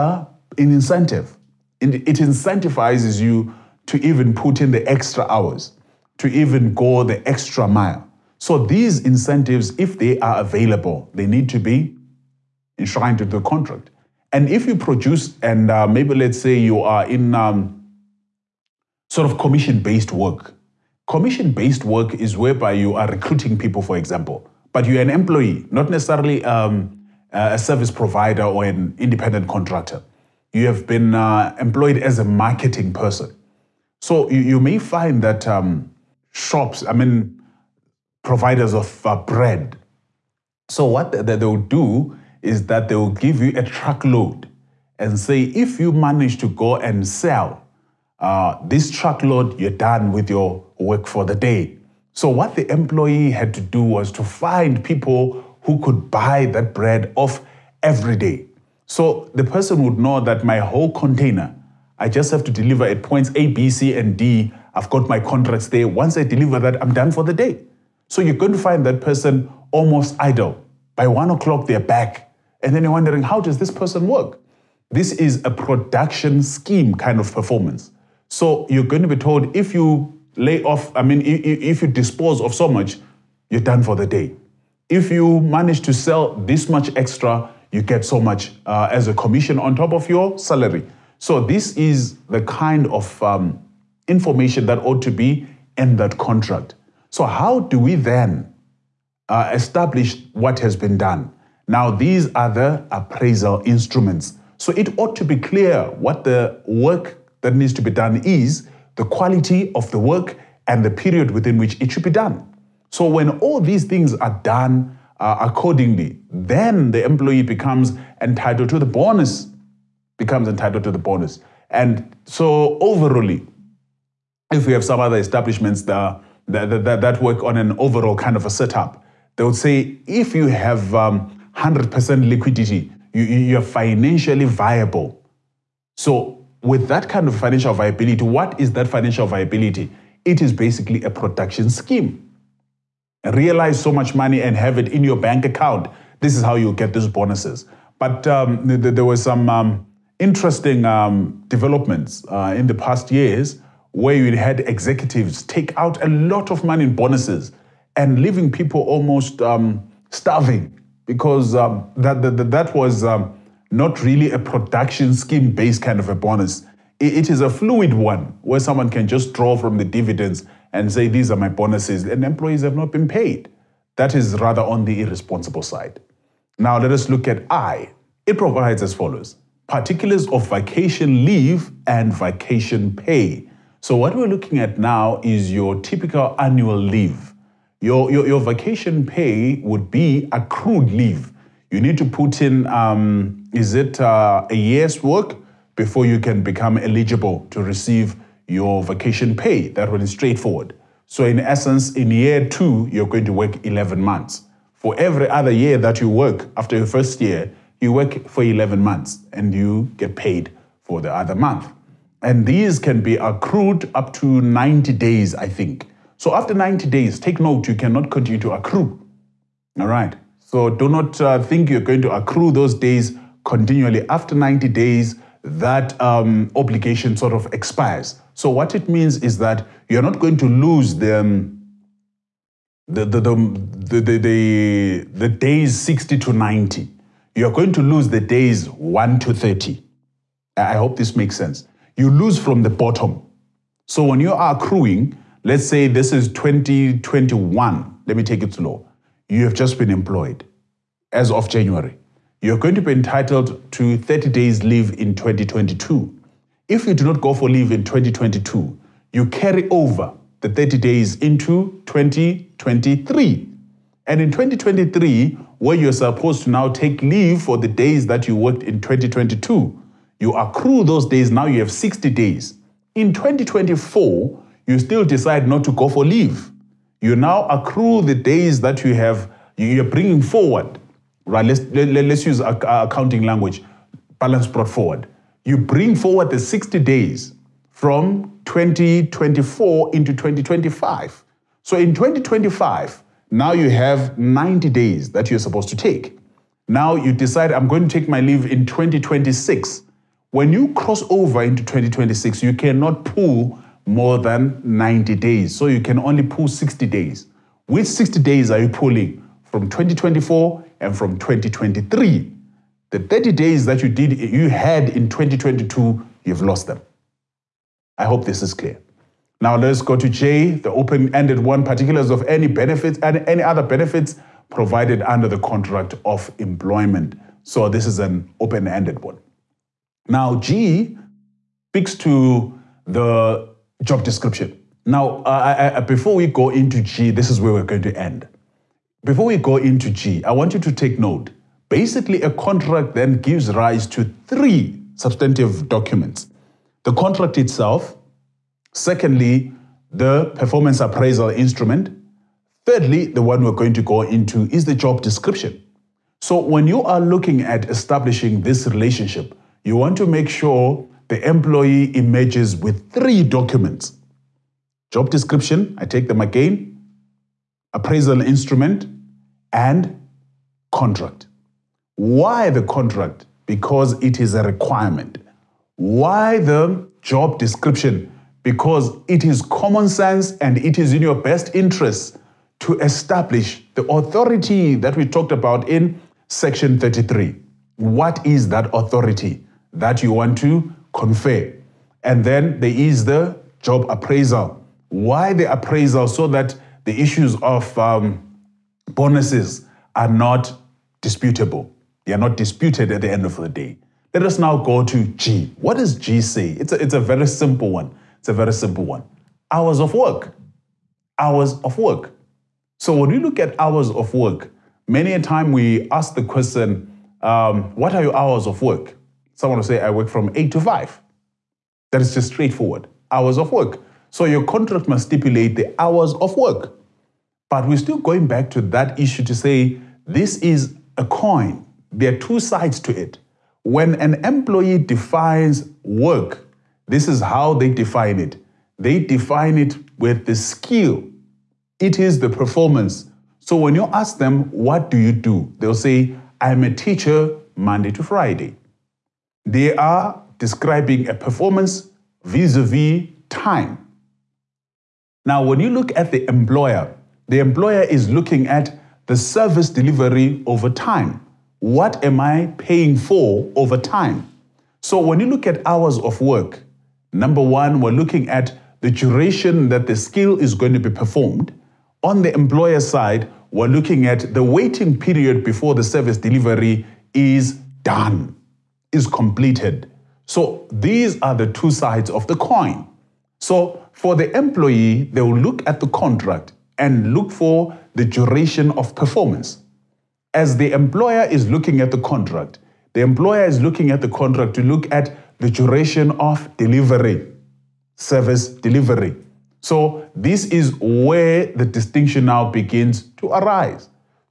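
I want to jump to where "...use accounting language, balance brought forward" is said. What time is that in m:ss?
4:42.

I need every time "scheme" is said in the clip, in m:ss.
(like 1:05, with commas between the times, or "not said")
1:16, 2:21, 2:45.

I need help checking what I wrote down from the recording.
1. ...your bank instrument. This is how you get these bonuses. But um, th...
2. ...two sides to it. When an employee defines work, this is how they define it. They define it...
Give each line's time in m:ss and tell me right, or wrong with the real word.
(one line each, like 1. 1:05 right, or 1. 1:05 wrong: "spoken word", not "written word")
1. 2:25 wrong: "account", not "instrument"
2. 7:12 right.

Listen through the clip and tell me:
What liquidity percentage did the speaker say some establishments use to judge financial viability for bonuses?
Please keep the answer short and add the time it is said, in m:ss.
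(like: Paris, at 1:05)
100%, at 2:11.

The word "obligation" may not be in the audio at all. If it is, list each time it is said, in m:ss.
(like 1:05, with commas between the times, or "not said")
3:46.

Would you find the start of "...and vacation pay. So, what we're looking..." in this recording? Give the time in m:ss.
3:01.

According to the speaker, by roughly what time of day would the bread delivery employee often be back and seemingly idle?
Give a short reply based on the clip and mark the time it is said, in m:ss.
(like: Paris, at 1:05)
1 o'clock, at 1:11.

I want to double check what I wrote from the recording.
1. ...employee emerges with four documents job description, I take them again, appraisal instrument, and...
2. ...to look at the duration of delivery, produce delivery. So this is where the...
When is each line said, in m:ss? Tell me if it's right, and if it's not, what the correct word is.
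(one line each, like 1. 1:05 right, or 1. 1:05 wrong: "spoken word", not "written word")
1. 6:01 wrong: "three", not "four"
2. 8:14 wrong: "service", not "produce".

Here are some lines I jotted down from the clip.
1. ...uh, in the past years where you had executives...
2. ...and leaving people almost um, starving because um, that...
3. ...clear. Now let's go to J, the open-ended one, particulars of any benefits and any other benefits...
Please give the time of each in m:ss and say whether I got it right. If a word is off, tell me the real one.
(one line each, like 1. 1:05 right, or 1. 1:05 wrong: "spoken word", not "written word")
1. 2:32 right
2. 2:37 right
3. 5:18 right.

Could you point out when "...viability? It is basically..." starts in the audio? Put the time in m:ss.
2:19.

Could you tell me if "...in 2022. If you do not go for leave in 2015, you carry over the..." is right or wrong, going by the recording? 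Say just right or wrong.
wrong.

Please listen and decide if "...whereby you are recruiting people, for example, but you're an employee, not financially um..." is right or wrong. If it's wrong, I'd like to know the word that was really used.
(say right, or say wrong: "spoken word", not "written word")
wrong: "necessarily", not "financially".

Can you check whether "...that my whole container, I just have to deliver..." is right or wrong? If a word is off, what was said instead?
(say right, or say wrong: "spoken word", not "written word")
right.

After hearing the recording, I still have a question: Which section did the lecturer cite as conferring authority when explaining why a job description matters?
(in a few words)
Section 33.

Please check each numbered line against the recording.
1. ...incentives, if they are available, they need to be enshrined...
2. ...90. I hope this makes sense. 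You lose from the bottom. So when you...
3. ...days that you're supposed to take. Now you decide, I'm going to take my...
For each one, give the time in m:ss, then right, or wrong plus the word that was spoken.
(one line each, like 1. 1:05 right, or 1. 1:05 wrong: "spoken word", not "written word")
1. 0:09 right
2. 3:59 wrong: "30", not "90"
3. 4:54 right.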